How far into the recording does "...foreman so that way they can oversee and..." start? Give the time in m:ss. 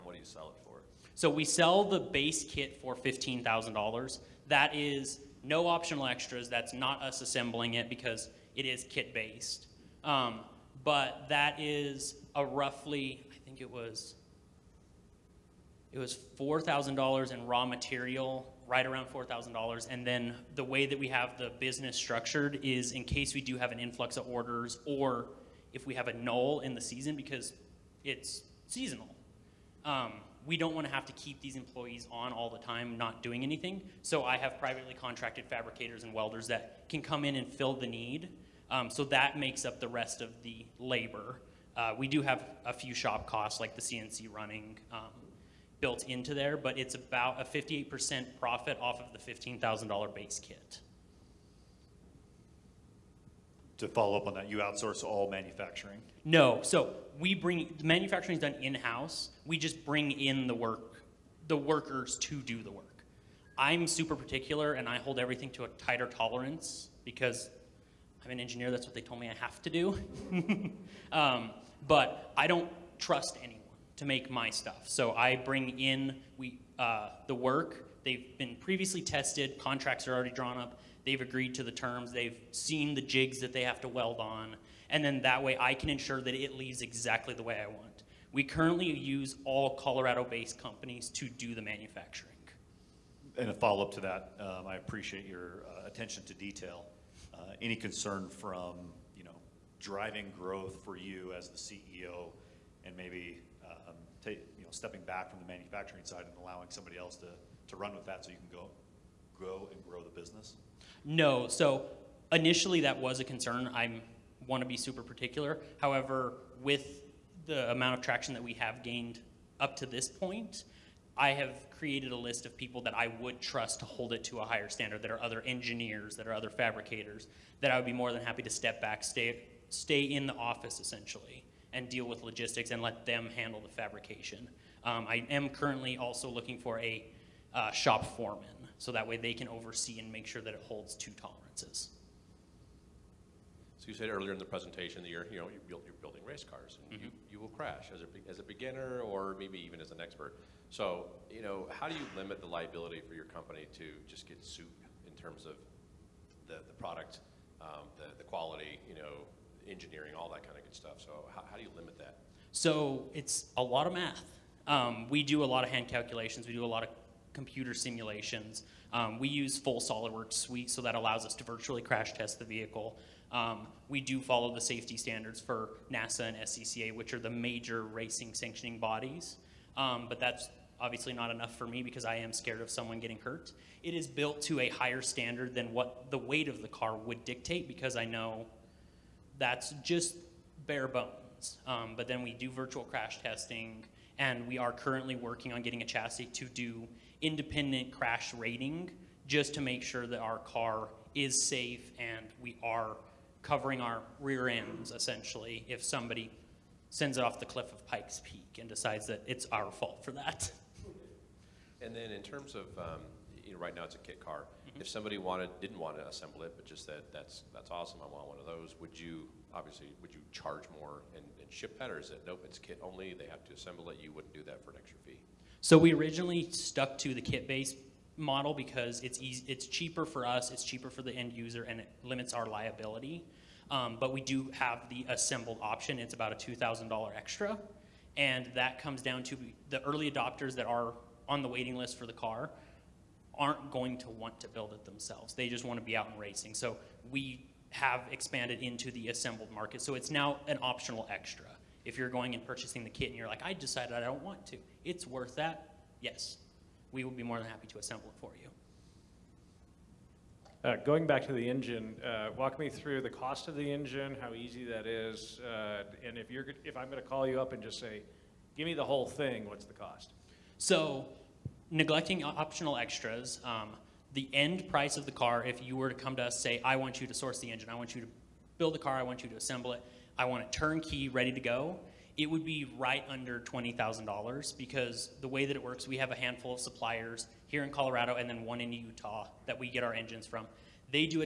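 2:18.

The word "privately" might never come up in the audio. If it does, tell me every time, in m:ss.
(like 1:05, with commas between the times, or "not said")
0:34.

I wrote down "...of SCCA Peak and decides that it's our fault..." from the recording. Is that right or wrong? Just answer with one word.
wrong.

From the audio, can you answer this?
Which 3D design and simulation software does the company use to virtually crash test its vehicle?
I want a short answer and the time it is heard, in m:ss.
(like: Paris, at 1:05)
SolidWorks, at 2:49.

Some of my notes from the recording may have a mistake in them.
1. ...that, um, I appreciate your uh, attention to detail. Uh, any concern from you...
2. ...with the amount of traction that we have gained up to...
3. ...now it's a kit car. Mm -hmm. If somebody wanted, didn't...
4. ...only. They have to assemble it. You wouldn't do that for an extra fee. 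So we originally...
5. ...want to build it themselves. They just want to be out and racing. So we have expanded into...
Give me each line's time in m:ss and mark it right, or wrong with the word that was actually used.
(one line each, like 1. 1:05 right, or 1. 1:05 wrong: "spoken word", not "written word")
1. 1:34 right
2. 1:56 right
3. 3:33 right
4. 3:42 right
5. 4:04 right.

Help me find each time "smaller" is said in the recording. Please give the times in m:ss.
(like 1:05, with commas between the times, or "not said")
not said.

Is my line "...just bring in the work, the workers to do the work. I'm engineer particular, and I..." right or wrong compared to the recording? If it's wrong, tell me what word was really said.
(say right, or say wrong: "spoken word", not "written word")
wrong: "super", not "engineer".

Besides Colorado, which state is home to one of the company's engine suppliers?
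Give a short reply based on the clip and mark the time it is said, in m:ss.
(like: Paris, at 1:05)
Utah, at 4:48.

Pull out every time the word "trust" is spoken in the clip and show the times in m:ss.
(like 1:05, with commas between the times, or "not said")
1:12, 2:03.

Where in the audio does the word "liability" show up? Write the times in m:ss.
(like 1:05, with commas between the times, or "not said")
2:32, 3:52.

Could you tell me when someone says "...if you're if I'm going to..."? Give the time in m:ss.
4:26.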